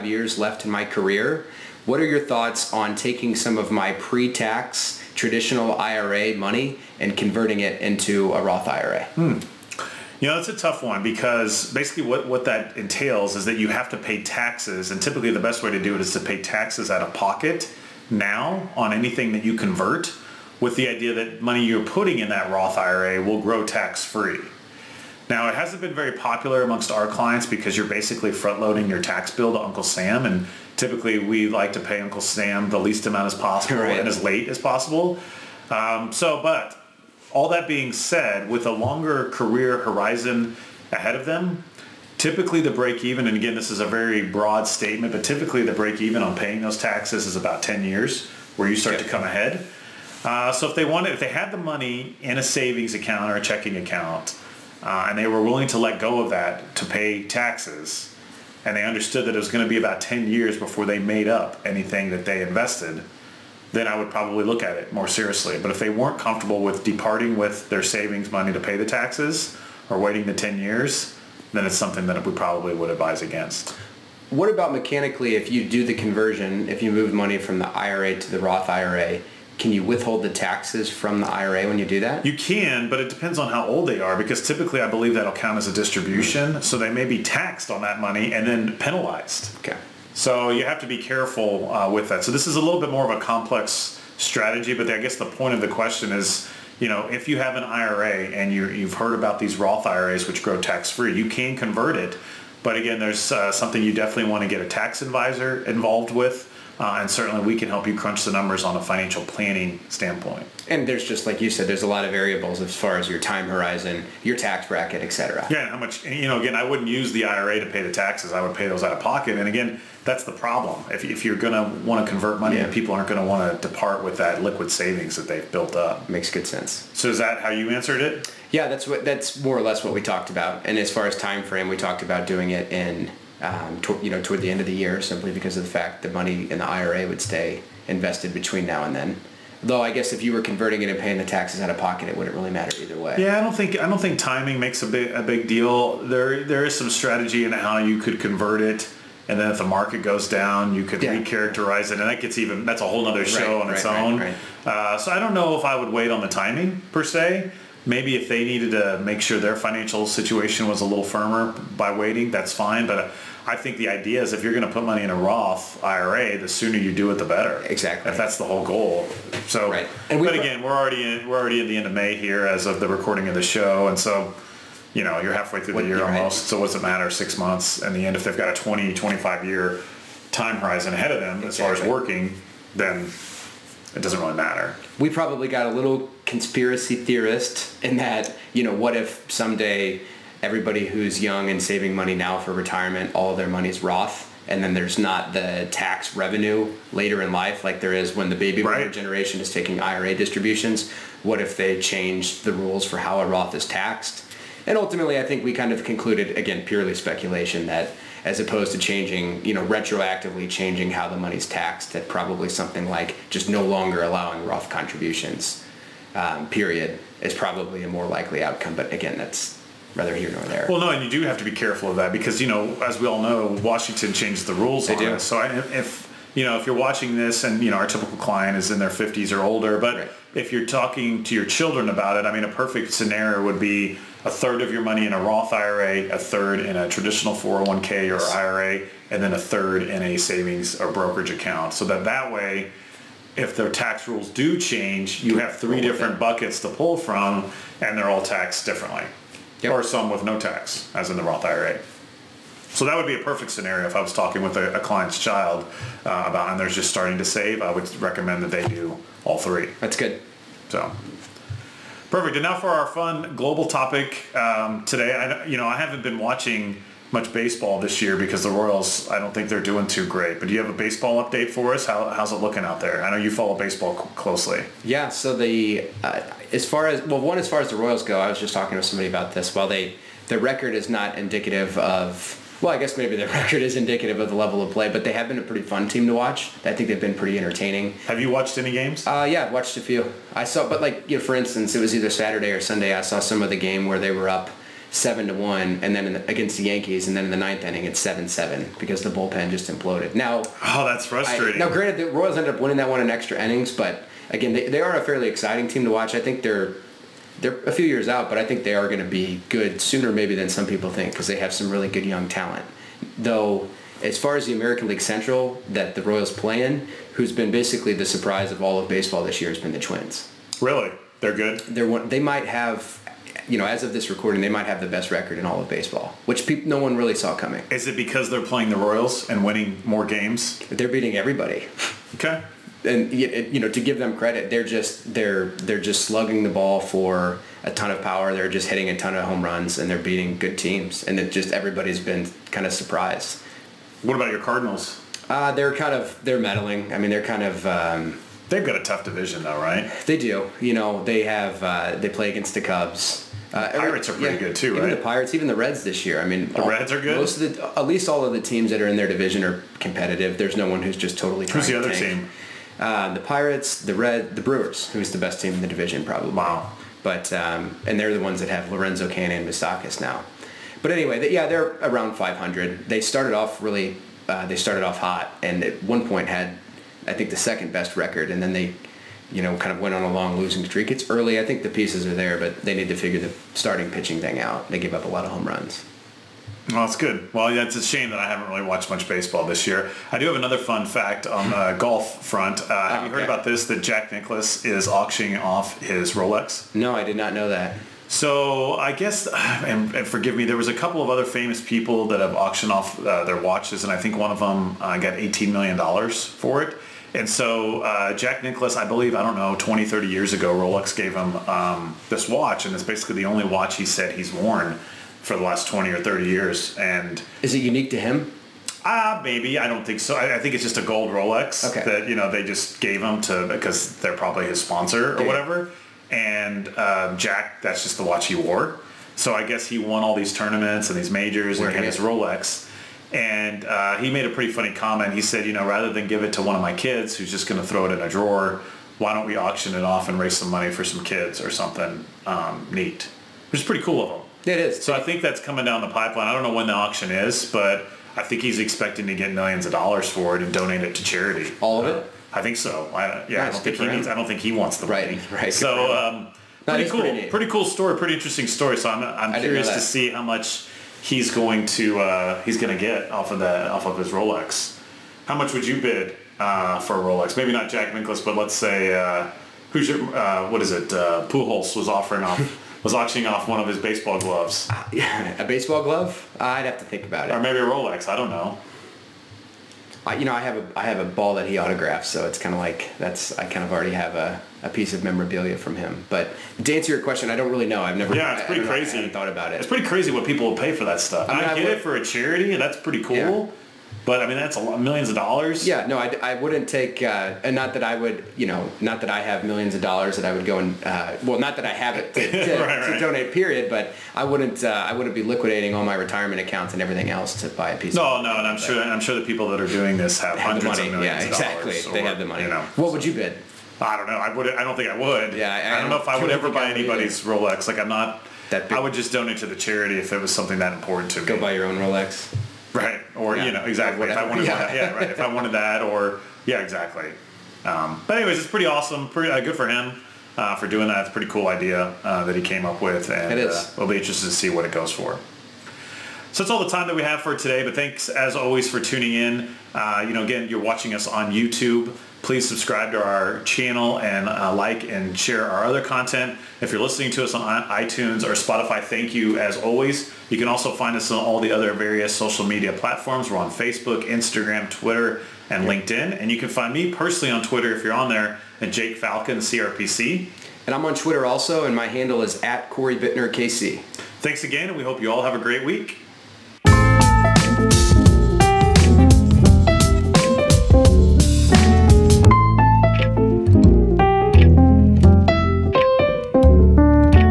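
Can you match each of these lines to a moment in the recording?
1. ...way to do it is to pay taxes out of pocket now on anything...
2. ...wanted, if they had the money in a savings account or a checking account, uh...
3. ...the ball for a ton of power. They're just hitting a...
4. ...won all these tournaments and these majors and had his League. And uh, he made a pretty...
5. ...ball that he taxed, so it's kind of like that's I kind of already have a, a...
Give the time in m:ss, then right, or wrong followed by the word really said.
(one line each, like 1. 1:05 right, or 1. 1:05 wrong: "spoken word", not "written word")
1. 0:15 right
2. 0:50 right
3. 5:36 right
4. 7:09 wrong: "Rolex", not "League"
5. 8:01 wrong: "autographed", not "taxed".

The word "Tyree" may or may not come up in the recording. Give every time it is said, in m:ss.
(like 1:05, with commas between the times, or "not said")
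not said.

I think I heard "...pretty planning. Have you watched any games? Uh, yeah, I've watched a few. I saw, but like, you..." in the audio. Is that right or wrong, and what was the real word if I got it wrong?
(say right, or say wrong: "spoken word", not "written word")
wrong: "entertaining", not "planning".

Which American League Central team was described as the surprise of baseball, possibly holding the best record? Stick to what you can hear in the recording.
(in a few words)
Twins.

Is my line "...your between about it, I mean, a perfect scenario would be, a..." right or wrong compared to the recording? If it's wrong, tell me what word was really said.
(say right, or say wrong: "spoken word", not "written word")
wrong: "children", not "between".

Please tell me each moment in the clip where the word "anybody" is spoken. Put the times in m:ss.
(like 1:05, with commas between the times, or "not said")
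8:36.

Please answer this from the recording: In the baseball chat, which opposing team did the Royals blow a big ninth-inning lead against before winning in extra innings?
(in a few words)
Yankees.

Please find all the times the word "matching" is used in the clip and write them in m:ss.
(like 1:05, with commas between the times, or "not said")
not said.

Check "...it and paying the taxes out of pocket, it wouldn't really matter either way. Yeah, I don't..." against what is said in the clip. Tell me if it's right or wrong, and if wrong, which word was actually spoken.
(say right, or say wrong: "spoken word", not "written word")
right.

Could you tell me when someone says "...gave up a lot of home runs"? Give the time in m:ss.
6:24.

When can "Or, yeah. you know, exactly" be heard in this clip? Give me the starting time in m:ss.
8:43.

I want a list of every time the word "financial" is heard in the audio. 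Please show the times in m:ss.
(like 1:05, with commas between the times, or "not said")
1:48, 2:39.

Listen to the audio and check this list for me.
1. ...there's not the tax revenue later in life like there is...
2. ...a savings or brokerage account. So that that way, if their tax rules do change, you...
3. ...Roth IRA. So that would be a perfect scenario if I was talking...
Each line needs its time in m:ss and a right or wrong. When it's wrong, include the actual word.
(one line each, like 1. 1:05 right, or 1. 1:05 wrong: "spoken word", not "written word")
1. 3:14 right
2. 4:00 right
3. 4:11 right.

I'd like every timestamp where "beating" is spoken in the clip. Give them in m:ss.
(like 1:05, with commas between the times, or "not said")
5:30, 5:39.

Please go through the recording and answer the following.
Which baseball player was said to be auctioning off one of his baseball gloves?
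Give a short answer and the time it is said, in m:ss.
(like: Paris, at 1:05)
Pujols, at 7:51.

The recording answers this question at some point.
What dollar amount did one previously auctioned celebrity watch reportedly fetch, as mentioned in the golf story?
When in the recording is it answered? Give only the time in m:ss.
6:45.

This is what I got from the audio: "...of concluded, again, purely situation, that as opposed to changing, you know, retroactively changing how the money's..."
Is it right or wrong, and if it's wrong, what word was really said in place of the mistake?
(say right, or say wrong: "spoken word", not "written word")
wrong: "speculation", not "situation".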